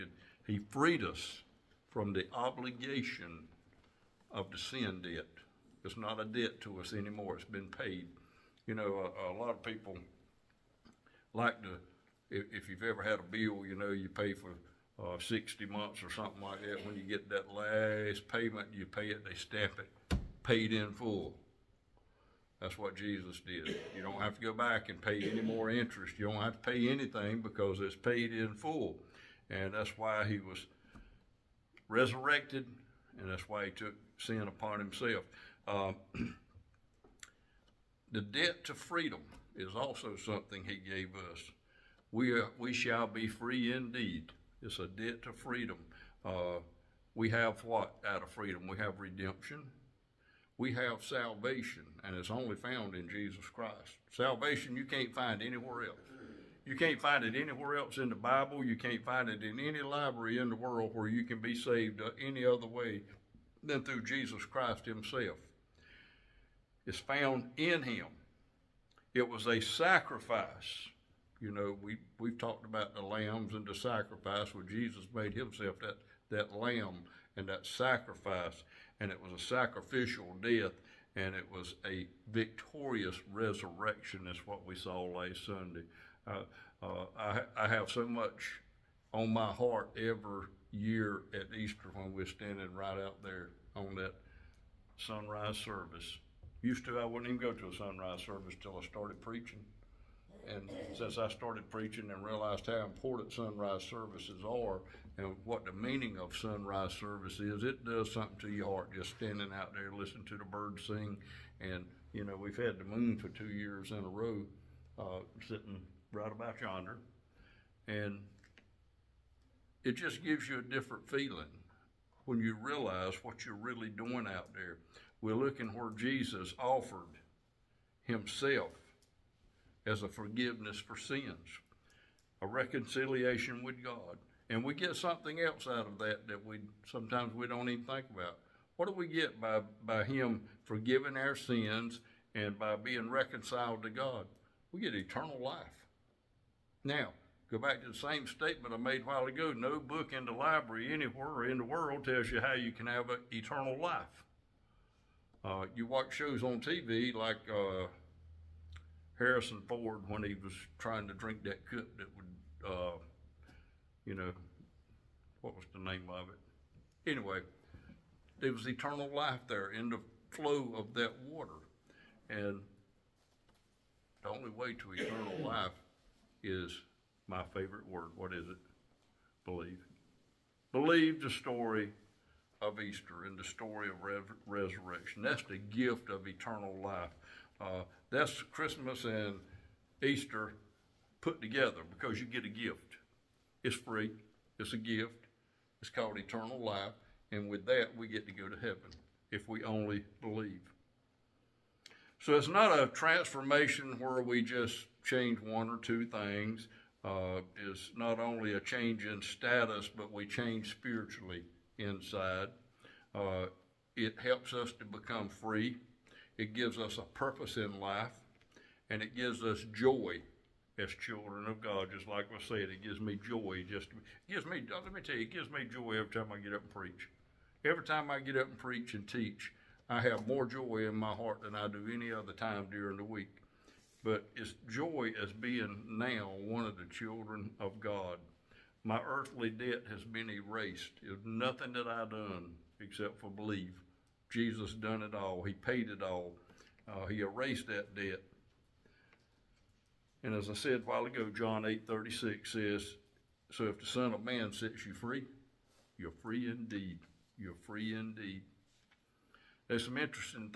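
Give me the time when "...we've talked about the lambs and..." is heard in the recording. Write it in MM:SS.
01:12.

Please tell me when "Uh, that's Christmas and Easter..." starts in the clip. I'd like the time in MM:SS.
03:07.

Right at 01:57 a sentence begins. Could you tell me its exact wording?
And it just gives you a different feeling when you realize what you're really doing out there.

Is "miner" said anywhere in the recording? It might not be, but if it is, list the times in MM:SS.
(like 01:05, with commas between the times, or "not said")
not said.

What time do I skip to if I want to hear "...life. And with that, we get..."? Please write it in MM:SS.
03:16.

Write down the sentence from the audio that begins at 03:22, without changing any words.
So it's not a transformation where we just change one or two things.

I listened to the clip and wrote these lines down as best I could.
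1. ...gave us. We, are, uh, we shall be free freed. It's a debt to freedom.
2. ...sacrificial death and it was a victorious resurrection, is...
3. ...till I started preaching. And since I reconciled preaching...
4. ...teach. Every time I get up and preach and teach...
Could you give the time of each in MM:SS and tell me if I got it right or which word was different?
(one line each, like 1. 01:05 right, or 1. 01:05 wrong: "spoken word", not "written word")
1. 00:40 wrong: "indeed", not "freed"
2. 01:19 right
3. 01:38 wrong: "started", not "reconciled"
4. 03:46 wrong: "preach", not "teach".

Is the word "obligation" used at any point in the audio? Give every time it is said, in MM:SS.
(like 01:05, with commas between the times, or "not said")
00:02.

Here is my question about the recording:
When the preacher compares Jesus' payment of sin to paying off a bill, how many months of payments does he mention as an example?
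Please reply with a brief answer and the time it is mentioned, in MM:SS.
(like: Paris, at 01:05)
60, at 00:15.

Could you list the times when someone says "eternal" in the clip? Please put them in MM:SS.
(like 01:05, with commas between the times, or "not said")
02:24, 02:33, 02:48, 02:54, 03:06, 03:16.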